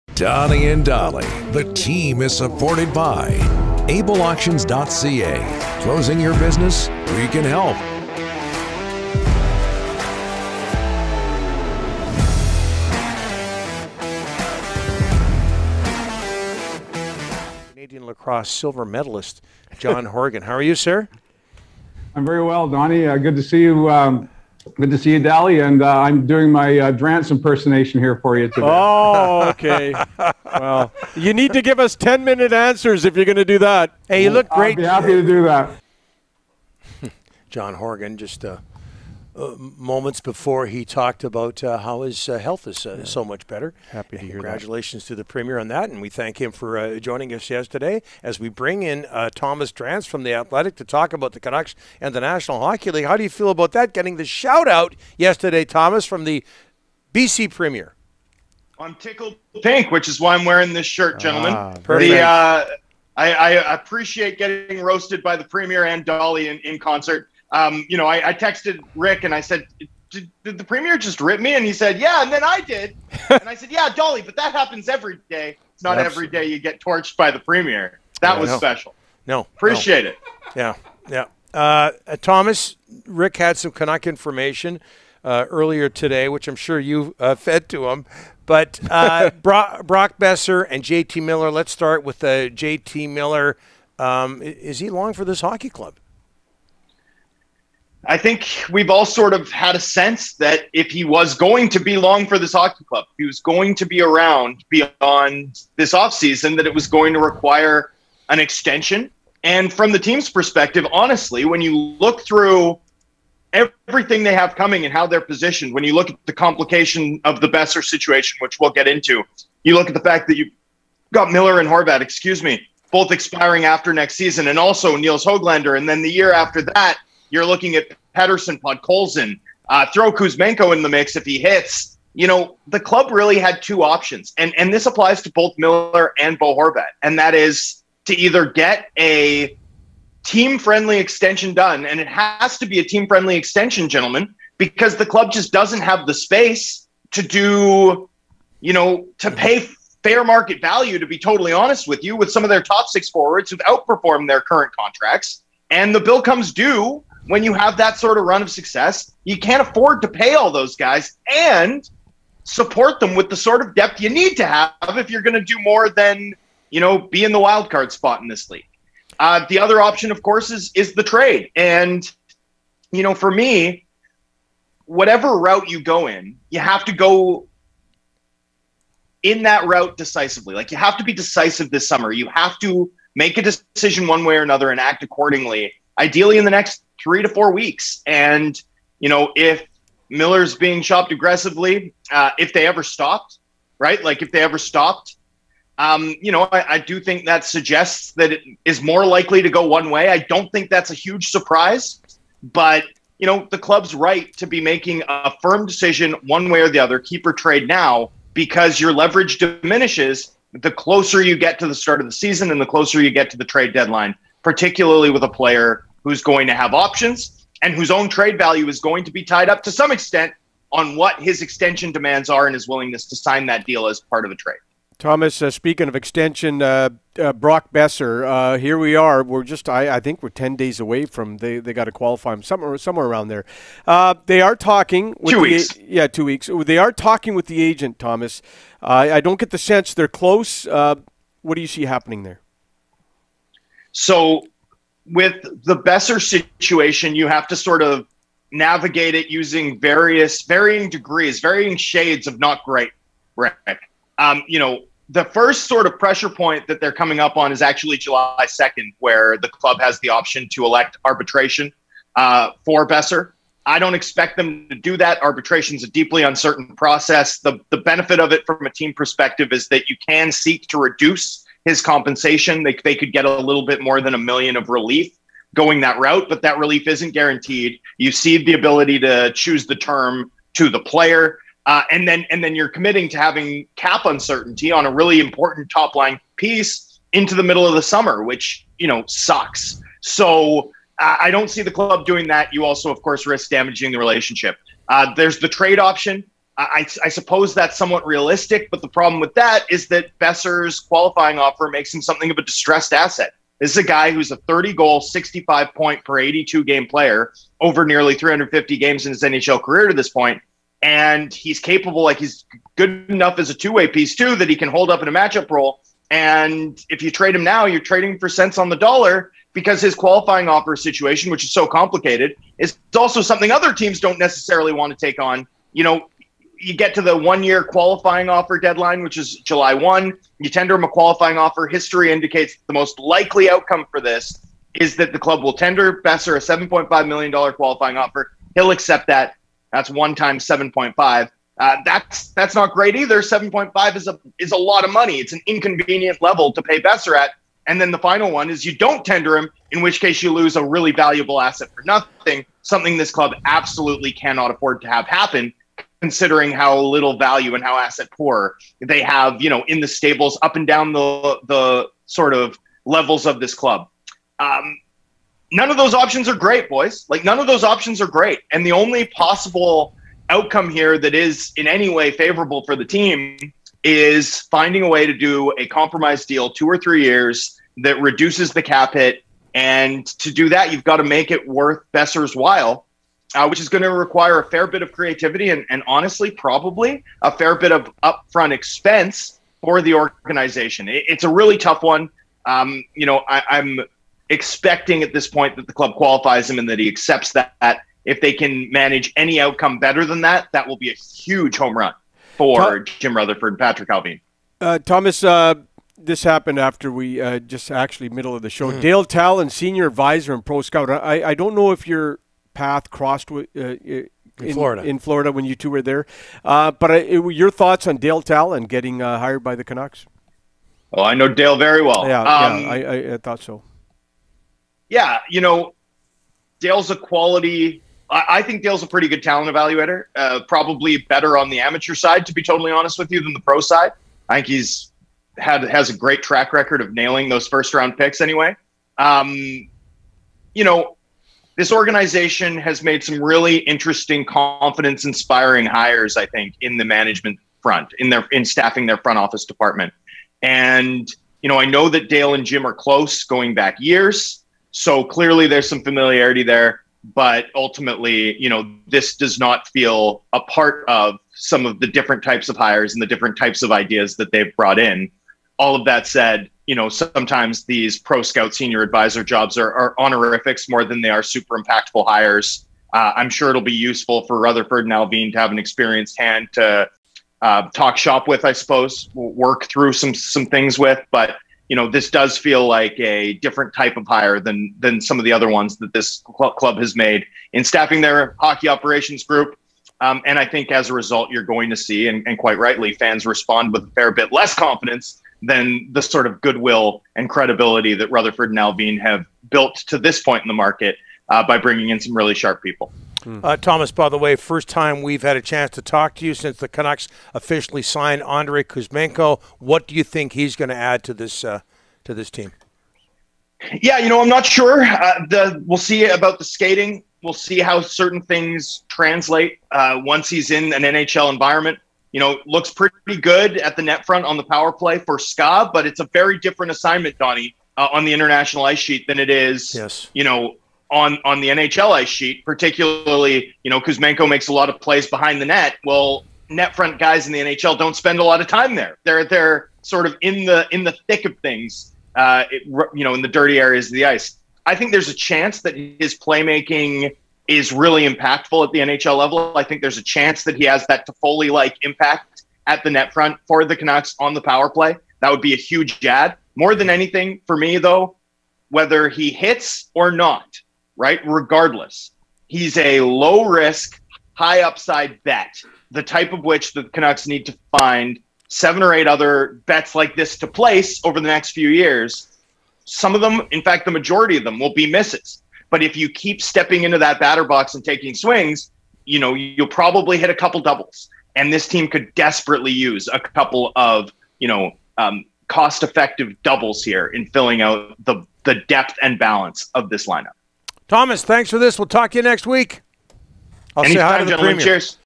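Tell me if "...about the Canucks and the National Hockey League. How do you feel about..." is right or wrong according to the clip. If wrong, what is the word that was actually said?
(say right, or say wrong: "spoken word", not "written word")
right.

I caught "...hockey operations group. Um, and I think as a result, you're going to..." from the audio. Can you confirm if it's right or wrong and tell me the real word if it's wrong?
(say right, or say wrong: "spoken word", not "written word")
right.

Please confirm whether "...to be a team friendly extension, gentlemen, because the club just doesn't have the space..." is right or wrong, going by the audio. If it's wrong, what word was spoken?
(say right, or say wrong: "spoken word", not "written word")
right.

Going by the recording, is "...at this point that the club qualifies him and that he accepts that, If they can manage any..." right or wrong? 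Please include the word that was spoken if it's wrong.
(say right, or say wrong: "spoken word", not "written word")
right.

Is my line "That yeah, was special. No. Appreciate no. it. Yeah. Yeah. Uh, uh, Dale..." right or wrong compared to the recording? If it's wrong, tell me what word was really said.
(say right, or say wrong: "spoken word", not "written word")
wrong: "Thomas", not "Dale".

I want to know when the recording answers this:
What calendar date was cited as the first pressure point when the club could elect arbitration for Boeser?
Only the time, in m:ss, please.
4:17.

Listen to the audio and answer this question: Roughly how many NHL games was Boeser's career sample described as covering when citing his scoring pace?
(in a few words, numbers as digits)
nearly 350.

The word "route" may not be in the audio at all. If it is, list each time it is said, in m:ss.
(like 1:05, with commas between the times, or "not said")
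2:55, 2:59, 4:35.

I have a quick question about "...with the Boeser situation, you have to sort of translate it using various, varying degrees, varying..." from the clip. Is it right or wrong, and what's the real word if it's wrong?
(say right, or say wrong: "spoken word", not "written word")
wrong: "navigate", not "translate".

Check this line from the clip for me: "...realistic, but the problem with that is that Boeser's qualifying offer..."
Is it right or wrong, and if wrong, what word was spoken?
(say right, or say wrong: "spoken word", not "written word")
right.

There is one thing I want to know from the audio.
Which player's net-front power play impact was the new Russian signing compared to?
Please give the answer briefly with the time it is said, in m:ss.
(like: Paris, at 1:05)
Toffoli, at 9:11.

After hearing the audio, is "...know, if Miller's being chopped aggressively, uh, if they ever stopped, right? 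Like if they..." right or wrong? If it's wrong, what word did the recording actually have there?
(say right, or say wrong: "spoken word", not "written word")
right.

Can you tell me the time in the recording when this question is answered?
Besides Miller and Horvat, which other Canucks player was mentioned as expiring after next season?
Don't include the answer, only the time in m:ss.
2:04.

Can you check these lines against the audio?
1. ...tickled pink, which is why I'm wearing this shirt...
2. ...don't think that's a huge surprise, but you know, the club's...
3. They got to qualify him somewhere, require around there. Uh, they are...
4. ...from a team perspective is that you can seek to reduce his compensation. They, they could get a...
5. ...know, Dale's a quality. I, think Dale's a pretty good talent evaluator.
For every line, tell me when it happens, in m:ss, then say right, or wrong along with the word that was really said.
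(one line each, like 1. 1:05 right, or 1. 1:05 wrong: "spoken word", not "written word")
1. 0:58 right
2. 3:20 right
3. 3:51 wrong: "somewhere", not "require"
4. 4:28 right
5. 7:05 right.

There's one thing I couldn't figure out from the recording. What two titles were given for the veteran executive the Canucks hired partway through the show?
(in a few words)
senior advisor and pro scout.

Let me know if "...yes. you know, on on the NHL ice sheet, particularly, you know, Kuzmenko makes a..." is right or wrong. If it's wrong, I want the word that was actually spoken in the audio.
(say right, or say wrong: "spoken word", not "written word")
right.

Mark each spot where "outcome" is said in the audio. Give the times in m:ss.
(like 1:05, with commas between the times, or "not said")
5:33, 6:10, 6:39.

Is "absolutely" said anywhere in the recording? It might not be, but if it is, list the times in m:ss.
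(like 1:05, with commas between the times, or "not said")
1:15, 5:53.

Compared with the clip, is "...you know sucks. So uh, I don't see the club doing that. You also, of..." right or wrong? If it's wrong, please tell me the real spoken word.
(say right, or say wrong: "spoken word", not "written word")
right.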